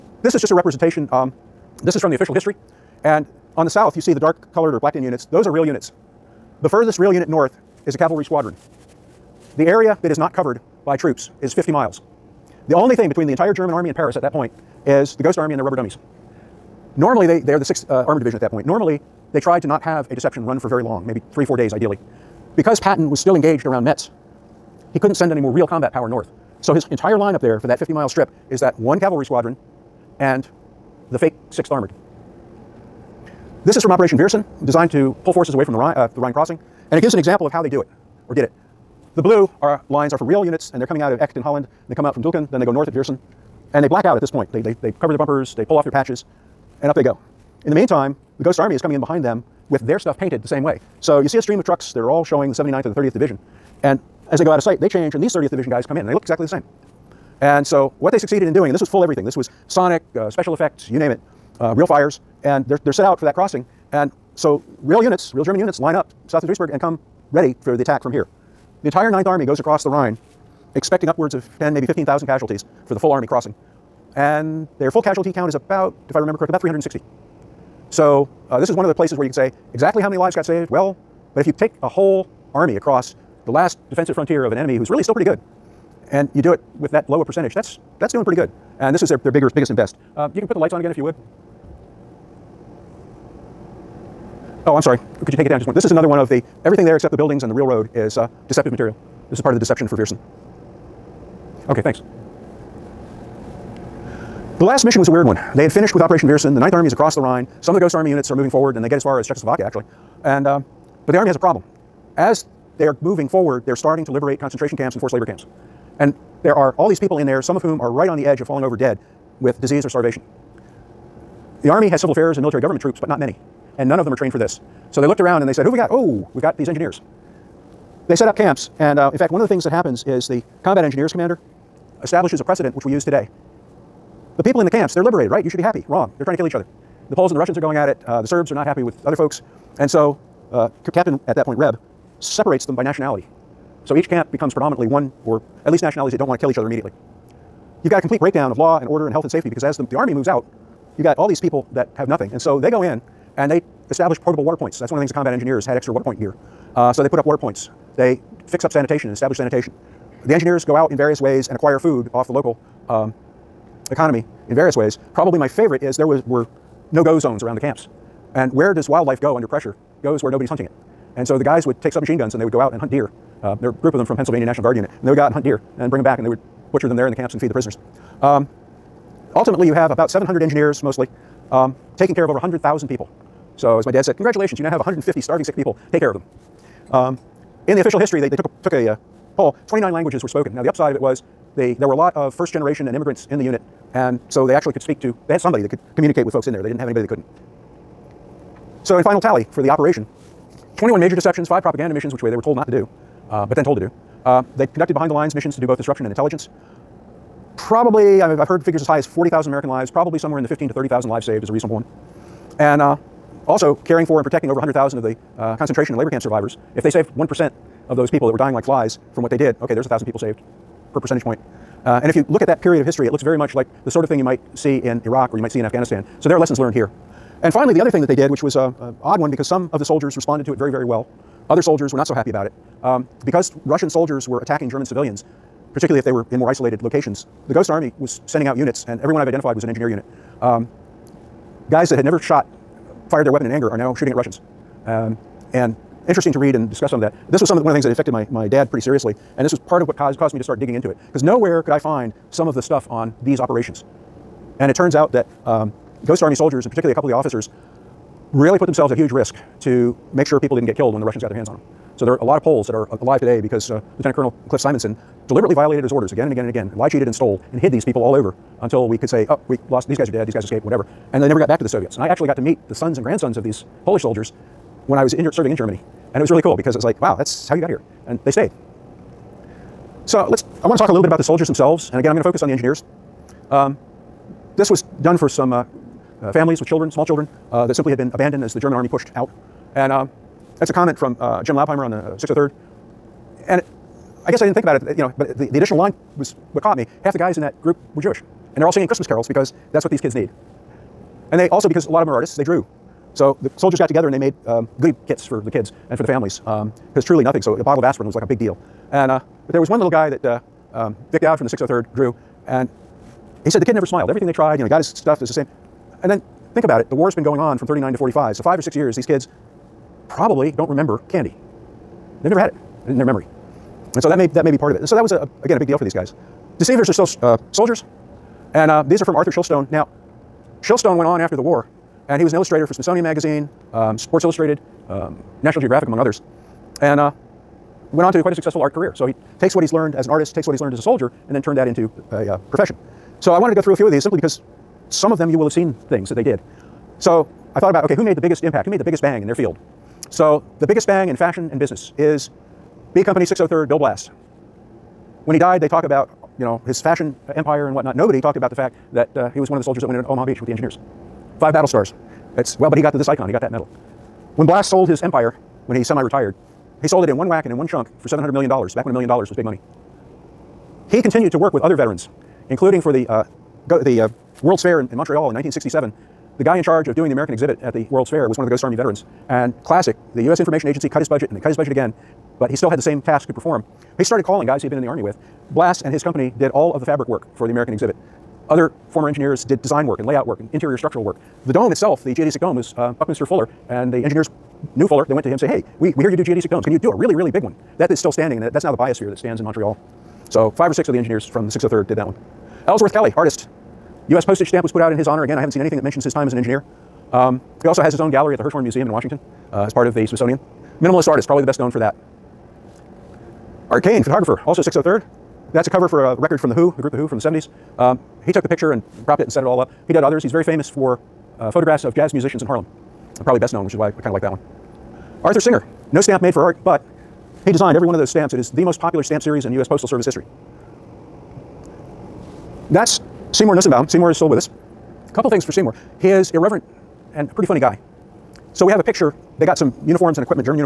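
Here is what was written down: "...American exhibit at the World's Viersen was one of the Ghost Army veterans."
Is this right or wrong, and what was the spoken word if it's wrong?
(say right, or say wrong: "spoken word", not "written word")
wrong: "Fair", not "Viersen".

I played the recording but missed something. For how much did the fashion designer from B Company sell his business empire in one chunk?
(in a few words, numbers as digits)
$700 million.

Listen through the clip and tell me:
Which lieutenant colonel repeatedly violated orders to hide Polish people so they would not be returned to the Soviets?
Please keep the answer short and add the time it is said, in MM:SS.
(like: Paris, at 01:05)
Cliff Simonson, at 04:24.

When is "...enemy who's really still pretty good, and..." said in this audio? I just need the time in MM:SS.
01:24.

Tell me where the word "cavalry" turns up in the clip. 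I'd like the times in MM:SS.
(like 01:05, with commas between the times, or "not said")
00:07, 00:28.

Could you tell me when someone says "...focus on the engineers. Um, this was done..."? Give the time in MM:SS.
04:42.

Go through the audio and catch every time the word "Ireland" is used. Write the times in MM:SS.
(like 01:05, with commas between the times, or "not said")
not said.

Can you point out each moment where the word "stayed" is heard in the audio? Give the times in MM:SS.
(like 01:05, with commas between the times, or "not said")
04:38.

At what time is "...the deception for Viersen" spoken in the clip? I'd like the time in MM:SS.
01:39.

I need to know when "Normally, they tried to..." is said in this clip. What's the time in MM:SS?
00:18.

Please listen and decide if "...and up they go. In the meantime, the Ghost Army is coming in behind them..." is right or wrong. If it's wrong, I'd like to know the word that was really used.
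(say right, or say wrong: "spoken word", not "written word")
right.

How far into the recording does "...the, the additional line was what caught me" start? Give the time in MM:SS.
04:55.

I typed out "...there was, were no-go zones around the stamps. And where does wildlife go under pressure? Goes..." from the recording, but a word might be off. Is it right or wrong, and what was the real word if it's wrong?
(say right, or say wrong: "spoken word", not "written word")
wrong: "camps", not "stamps".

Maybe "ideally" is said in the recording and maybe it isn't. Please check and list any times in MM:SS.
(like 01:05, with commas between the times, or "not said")
00:21.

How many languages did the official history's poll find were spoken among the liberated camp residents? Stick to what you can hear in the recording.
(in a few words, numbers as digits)
29.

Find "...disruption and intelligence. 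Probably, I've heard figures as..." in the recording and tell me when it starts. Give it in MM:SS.
03:25.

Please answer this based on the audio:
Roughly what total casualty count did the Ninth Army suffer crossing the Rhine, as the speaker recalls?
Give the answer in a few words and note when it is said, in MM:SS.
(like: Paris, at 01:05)
360, at 01:16.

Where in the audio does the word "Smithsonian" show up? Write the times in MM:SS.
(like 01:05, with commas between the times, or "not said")
05:32, 06:50.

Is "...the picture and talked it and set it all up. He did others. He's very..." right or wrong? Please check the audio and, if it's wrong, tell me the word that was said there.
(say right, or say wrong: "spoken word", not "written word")
wrong: "cropped", not "talked".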